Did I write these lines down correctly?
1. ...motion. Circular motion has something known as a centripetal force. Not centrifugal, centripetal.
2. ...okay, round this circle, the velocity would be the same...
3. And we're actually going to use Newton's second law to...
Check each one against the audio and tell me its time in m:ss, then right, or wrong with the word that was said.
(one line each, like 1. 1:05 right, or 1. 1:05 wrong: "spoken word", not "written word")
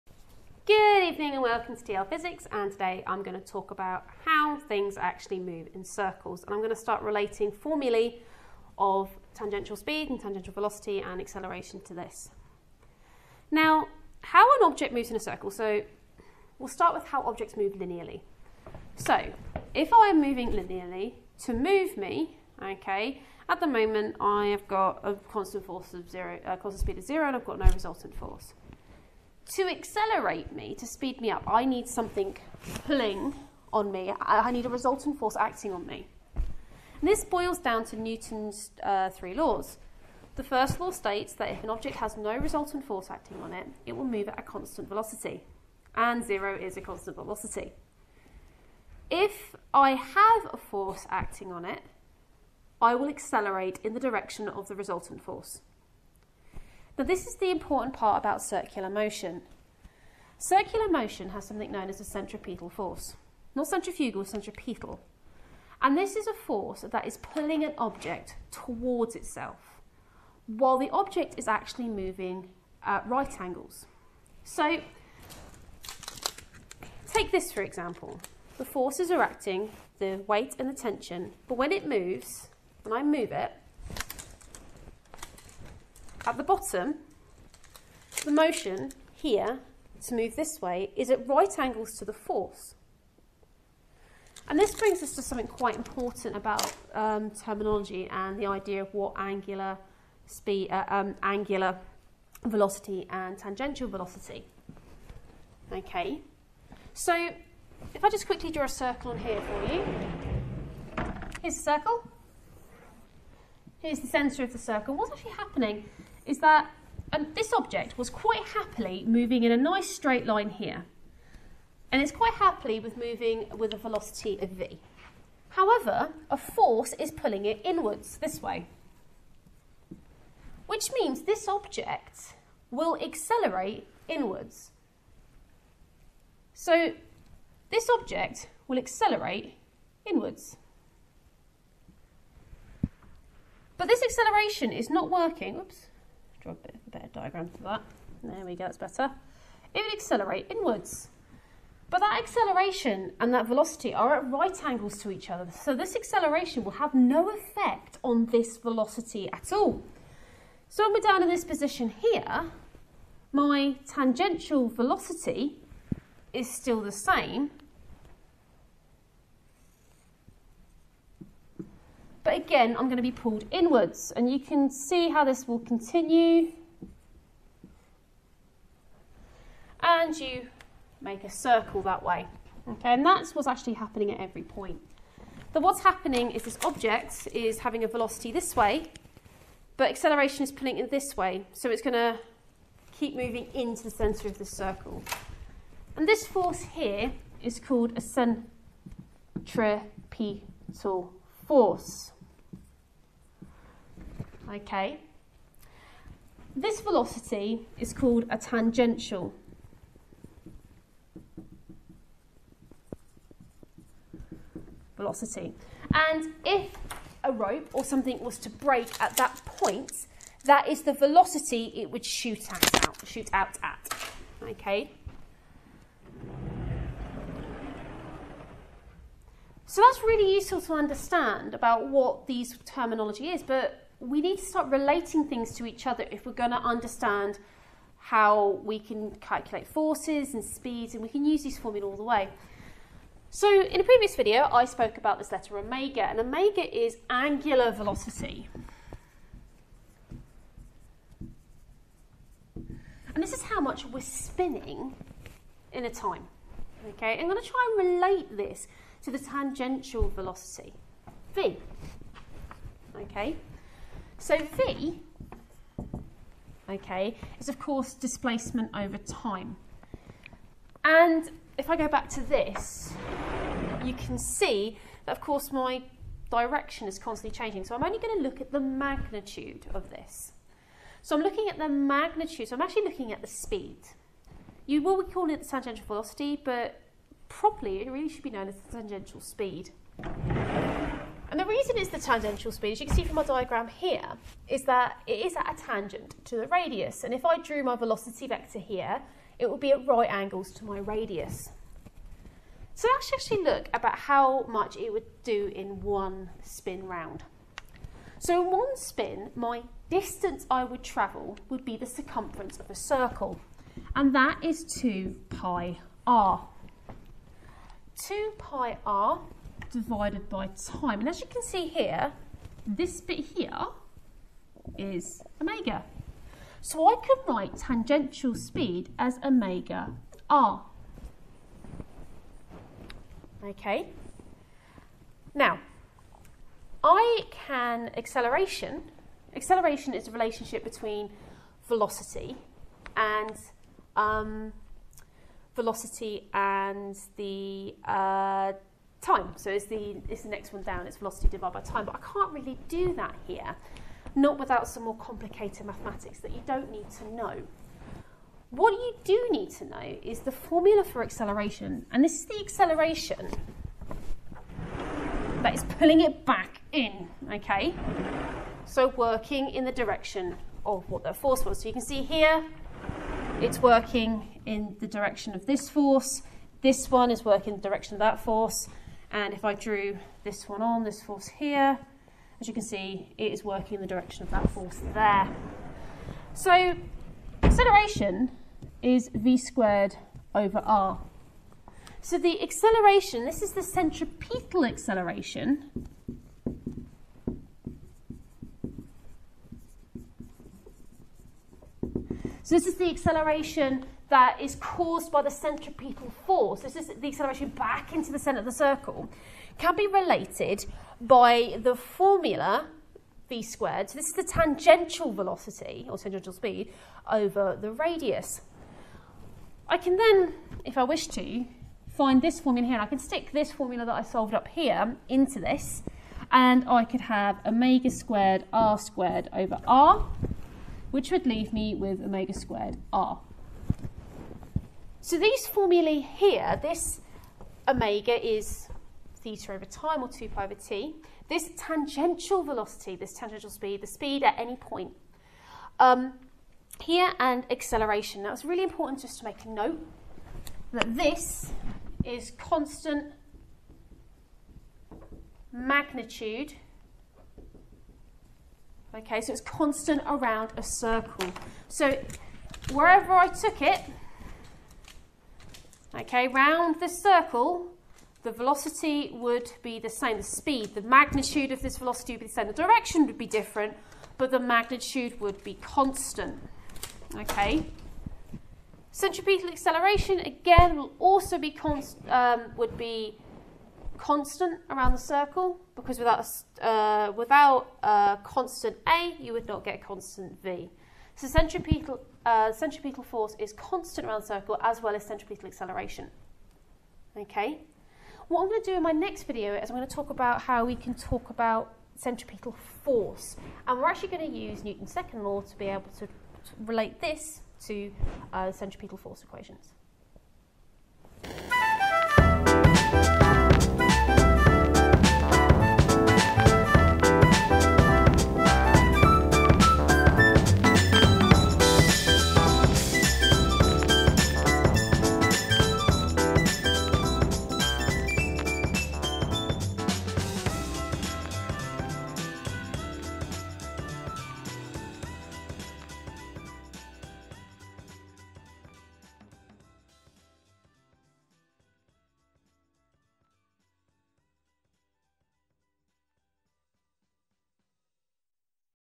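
1. 0:58 right
2. 7:46 right
3. 8:23 right.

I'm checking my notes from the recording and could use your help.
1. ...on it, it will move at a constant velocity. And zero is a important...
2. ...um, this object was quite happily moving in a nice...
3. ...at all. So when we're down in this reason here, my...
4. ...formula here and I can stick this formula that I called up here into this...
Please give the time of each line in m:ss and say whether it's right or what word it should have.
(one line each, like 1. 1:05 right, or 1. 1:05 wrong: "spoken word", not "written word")
1. 0:43 wrong: "constant", not "important"
2. 1:57 right
3. 2:39 wrong: "position", not "reason"
4. 7:02 wrong: "solved", not "called".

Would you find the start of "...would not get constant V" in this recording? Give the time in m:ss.
8:09.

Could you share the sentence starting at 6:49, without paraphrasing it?
Can be related by the formula v squared.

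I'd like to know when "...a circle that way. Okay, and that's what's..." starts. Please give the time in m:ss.
3:01.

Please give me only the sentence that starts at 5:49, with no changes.
So it's the, it's the next one down, it's velocity divided by time.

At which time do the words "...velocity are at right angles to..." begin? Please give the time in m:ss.
2:33.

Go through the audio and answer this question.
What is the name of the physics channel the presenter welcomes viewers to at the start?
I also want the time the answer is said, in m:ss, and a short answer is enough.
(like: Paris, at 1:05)
TL Physics, at 0:01.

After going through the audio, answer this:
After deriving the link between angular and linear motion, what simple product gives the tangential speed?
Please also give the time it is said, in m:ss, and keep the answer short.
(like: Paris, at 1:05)
omega r, at 5:29.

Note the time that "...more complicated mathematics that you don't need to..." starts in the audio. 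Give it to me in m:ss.
5:54.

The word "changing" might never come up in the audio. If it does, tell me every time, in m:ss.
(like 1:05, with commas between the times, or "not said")
4:37.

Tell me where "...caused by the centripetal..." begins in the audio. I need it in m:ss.
6:44.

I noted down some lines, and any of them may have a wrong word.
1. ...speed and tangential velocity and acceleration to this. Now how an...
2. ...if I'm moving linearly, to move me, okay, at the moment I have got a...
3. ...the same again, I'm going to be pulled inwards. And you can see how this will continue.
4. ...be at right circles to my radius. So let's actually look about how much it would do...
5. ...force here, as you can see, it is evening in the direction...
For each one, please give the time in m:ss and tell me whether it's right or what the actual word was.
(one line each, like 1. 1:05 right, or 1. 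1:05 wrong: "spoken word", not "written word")
1. 0:09 right
2. 0:19 right
3. 2:46 right
4. 4:59 wrong: "angles", not "circles"
5. 6:21 wrong: "working", not "evening".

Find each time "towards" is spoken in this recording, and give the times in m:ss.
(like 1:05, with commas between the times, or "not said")
1:08.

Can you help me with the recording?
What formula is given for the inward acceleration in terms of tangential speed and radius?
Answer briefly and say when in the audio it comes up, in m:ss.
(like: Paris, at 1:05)
v squared over r, at 6:29.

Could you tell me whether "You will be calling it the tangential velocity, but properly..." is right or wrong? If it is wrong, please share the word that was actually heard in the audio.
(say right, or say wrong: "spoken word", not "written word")
right.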